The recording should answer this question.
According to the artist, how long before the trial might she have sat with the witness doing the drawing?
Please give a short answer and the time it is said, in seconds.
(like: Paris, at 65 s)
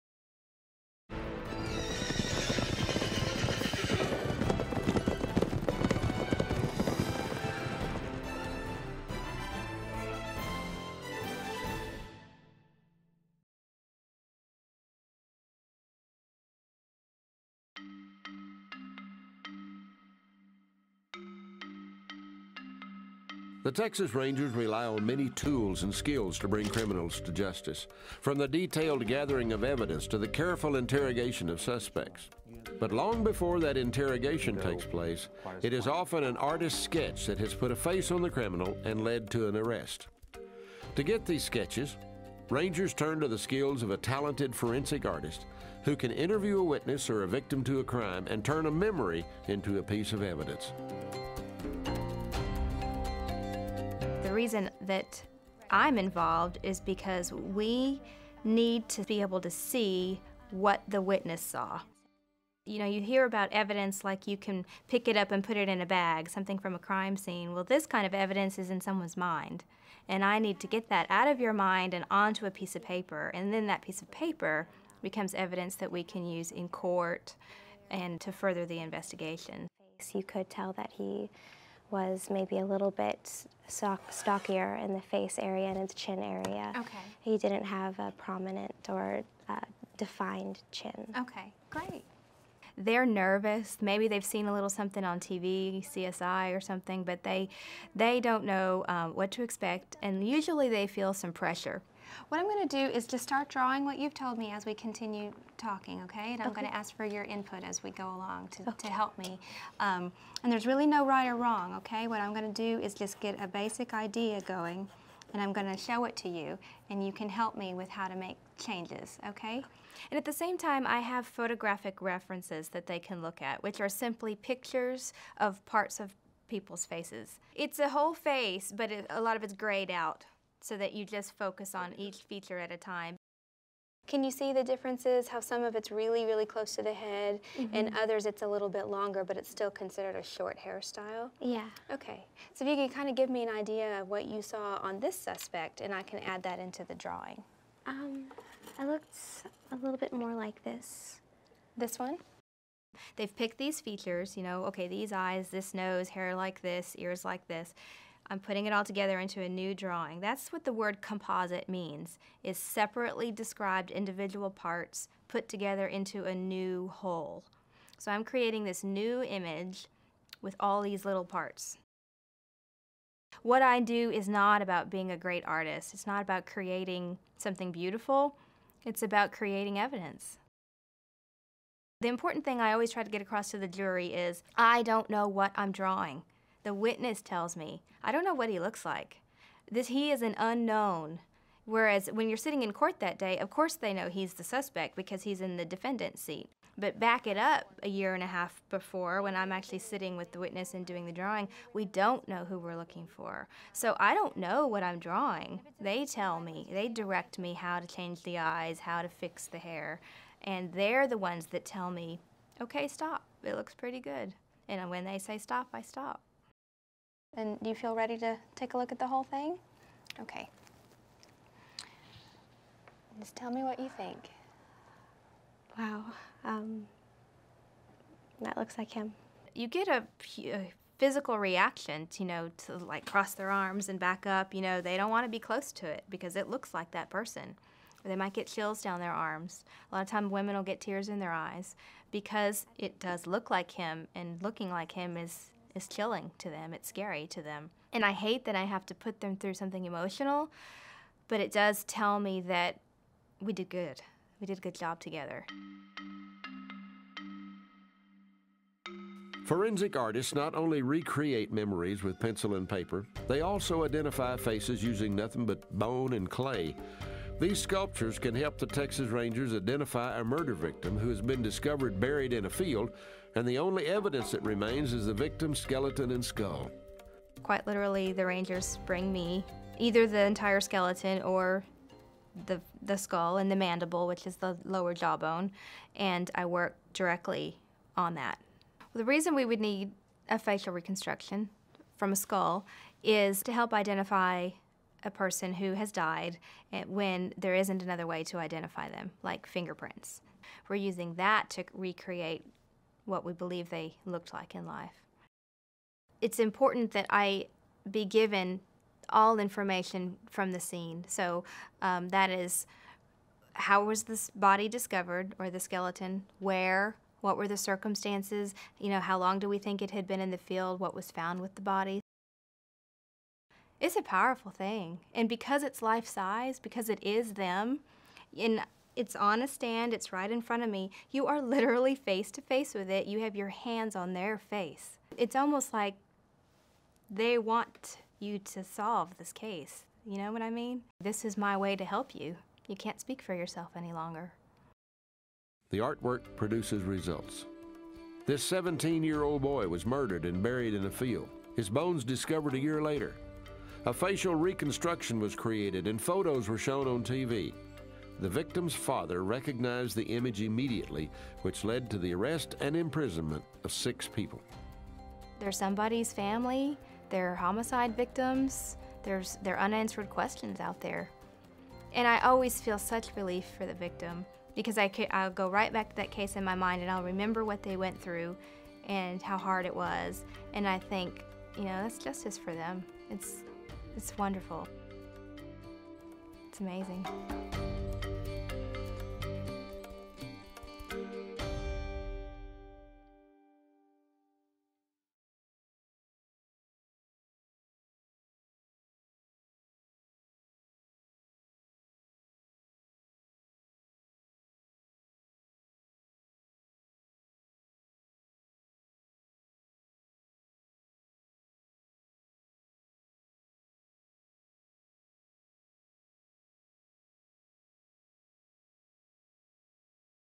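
a year and a half, at 197 s.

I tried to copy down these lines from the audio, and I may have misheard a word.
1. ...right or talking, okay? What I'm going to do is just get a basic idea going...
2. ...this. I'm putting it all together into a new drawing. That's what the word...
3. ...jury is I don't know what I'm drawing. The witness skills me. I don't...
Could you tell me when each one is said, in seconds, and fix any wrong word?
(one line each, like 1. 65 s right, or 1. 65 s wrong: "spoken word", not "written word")
1. 111 s wrong: "wrong", not "talking"
2. 157 s right
3. 183 s wrong: "tells", not "skills".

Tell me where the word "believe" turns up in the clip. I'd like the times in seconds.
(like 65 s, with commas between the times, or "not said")
303 s.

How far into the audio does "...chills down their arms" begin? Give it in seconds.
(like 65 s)
238 s.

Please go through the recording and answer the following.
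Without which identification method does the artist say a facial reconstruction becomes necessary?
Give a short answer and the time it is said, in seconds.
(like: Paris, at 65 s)
fingerprints, at 299 s.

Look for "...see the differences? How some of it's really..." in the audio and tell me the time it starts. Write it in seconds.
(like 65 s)
134 s.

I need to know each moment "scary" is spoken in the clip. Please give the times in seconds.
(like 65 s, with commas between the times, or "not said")
246 s.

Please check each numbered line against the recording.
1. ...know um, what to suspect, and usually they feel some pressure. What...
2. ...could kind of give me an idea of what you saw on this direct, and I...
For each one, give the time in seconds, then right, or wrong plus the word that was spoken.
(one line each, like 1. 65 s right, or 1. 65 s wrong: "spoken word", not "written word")
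1. 98 s wrong: "expect", not "suspect"
2. 142 s wrong: "suspect", not "direct".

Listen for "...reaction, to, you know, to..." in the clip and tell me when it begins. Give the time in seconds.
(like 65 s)
231 s.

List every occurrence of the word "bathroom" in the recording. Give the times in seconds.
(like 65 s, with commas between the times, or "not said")
not said.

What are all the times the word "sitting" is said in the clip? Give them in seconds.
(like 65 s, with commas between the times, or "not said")
192 s, 199 s.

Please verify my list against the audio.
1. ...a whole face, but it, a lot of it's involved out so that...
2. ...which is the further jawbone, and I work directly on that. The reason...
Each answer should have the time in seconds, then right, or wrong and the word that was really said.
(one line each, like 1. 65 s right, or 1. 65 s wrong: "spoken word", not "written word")
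1. 127 s wrong: "grayed", not "involved"
2. 284 s wrong: "lower", not "further".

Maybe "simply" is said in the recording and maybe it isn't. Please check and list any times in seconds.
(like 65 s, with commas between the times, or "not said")
123 s.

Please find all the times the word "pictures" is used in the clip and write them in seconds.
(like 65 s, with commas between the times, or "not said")
124 s.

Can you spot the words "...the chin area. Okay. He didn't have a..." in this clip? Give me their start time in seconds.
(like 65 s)
85 s.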